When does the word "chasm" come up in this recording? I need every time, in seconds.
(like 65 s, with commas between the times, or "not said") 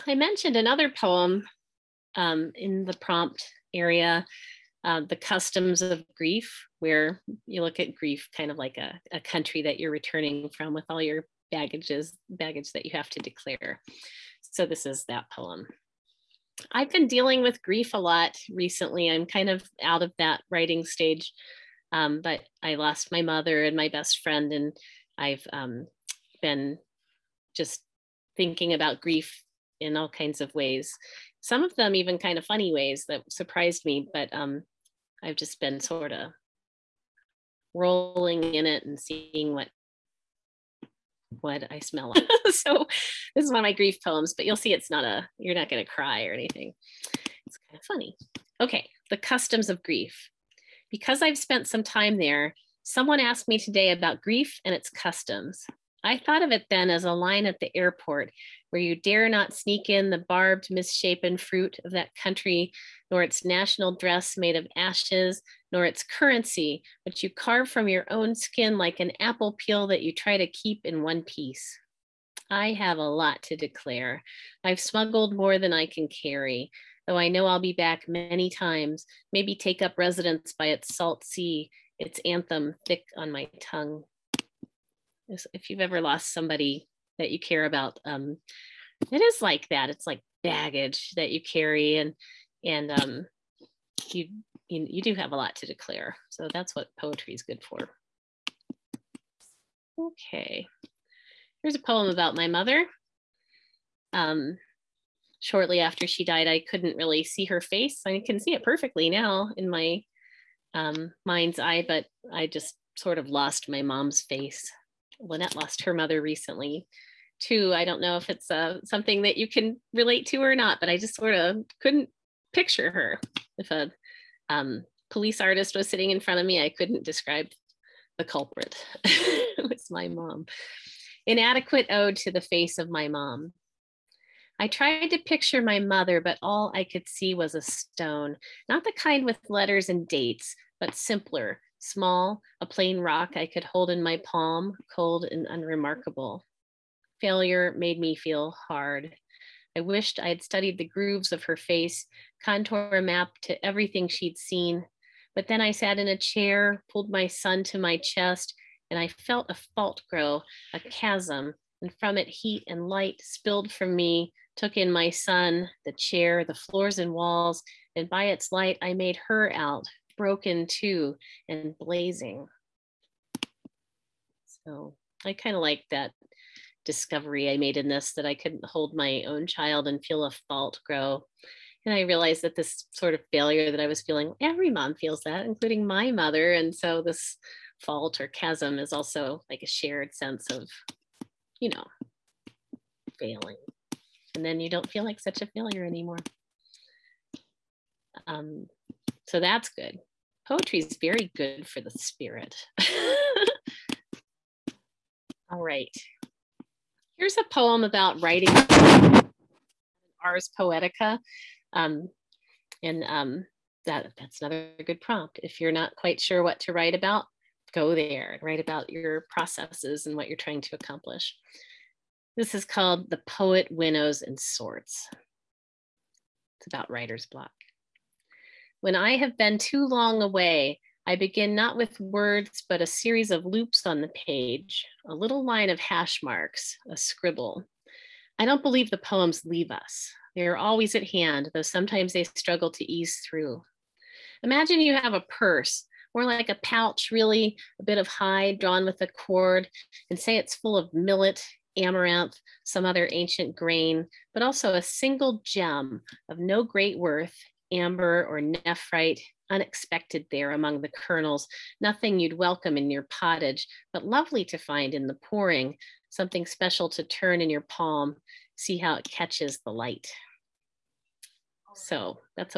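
160 s, 188 s.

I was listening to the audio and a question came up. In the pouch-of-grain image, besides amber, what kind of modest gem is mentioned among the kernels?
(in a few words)
Nephrite.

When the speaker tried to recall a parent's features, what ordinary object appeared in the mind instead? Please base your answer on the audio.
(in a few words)
A stone.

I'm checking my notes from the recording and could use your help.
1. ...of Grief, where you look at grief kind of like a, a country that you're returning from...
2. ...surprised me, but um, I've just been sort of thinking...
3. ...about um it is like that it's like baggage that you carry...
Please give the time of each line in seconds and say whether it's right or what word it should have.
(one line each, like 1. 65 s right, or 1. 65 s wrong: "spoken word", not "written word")
1. 5 s right
2. 33 s wrong: "rolling", not "thinking"
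3. 87 s right.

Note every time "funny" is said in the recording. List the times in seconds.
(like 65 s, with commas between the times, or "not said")
32 s, 47 s.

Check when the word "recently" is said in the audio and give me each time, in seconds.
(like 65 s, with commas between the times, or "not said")
18 s, 116 s.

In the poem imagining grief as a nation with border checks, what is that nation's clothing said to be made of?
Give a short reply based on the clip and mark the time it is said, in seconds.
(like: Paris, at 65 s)
Ashes, at 64 s.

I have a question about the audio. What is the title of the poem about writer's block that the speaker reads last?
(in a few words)
The Poet Winnows and Sorts.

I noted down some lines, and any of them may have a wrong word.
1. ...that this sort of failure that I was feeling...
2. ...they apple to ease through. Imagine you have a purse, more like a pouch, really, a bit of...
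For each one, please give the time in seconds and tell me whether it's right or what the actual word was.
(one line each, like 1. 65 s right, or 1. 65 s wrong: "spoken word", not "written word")
1. 182 s right
2. 242 s wrong: "struggle", not "apple".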